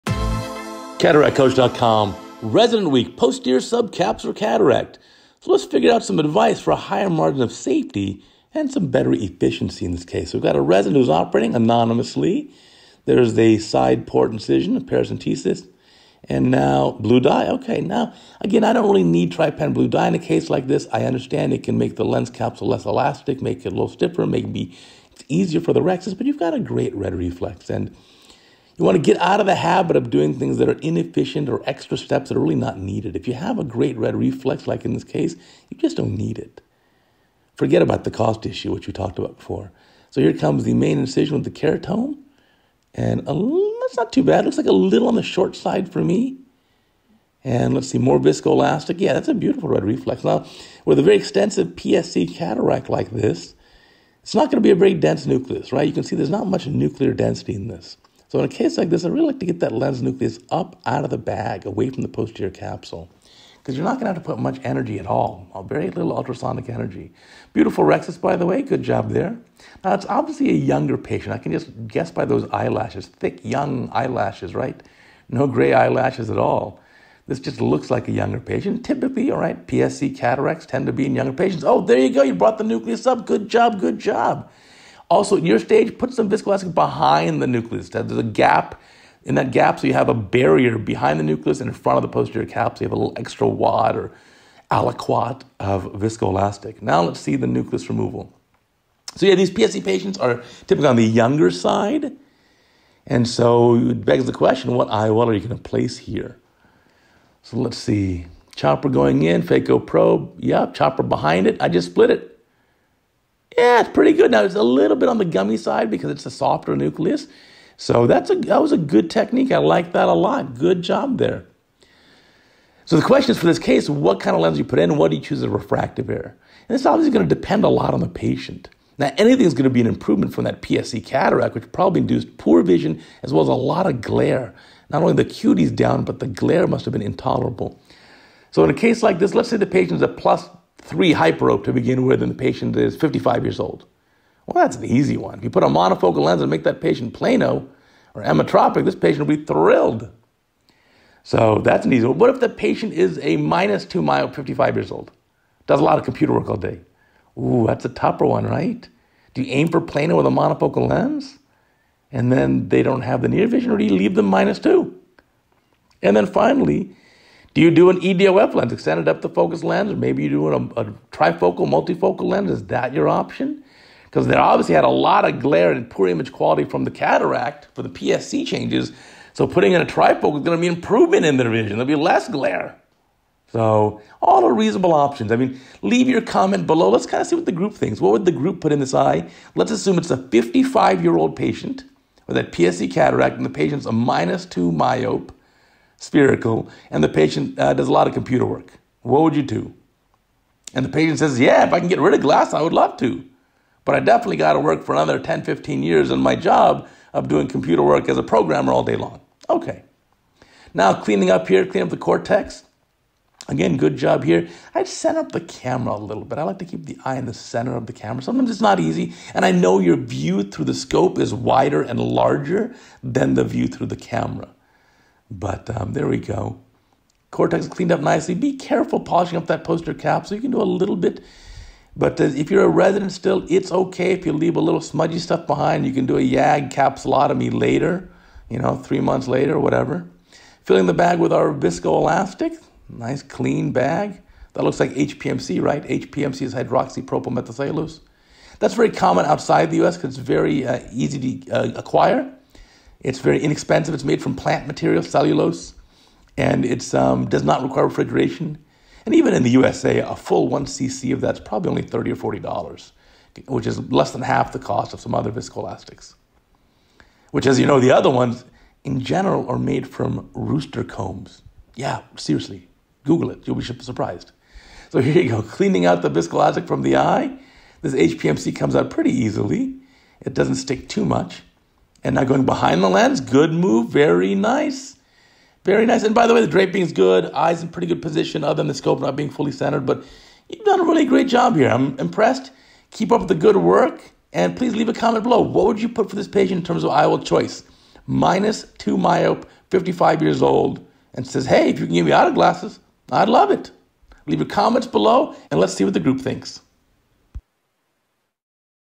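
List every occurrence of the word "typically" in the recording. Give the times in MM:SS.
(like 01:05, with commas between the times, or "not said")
01:18, 01:40.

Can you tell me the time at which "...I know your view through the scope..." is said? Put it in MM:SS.
03:39.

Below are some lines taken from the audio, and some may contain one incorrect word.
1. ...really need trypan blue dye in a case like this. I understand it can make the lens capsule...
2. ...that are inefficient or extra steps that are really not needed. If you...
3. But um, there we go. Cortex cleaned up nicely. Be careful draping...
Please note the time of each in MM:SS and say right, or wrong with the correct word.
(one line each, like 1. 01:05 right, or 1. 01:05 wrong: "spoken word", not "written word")
1. 00:18 right
2. 00:30 right
3. 03:45 wrong: "polishing", not "draping".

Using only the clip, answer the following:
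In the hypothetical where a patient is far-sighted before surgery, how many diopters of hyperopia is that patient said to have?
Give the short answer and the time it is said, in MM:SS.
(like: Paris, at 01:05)
plus 3, at 02:20.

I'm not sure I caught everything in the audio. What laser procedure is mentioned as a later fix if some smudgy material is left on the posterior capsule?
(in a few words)
YAG capsulotomy.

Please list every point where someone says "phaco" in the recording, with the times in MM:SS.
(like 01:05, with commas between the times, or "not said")
01:49.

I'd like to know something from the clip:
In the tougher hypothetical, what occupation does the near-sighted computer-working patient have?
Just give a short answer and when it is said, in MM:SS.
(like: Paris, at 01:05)
programmer, at 03:28.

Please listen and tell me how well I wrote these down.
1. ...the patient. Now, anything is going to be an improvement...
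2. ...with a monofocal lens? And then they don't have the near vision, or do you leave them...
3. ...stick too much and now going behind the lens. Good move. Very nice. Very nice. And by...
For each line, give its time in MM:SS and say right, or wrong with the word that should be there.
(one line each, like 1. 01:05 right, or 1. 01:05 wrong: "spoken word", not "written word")
1. 02:07 right
2. 02:40 right
3. 04:40 right.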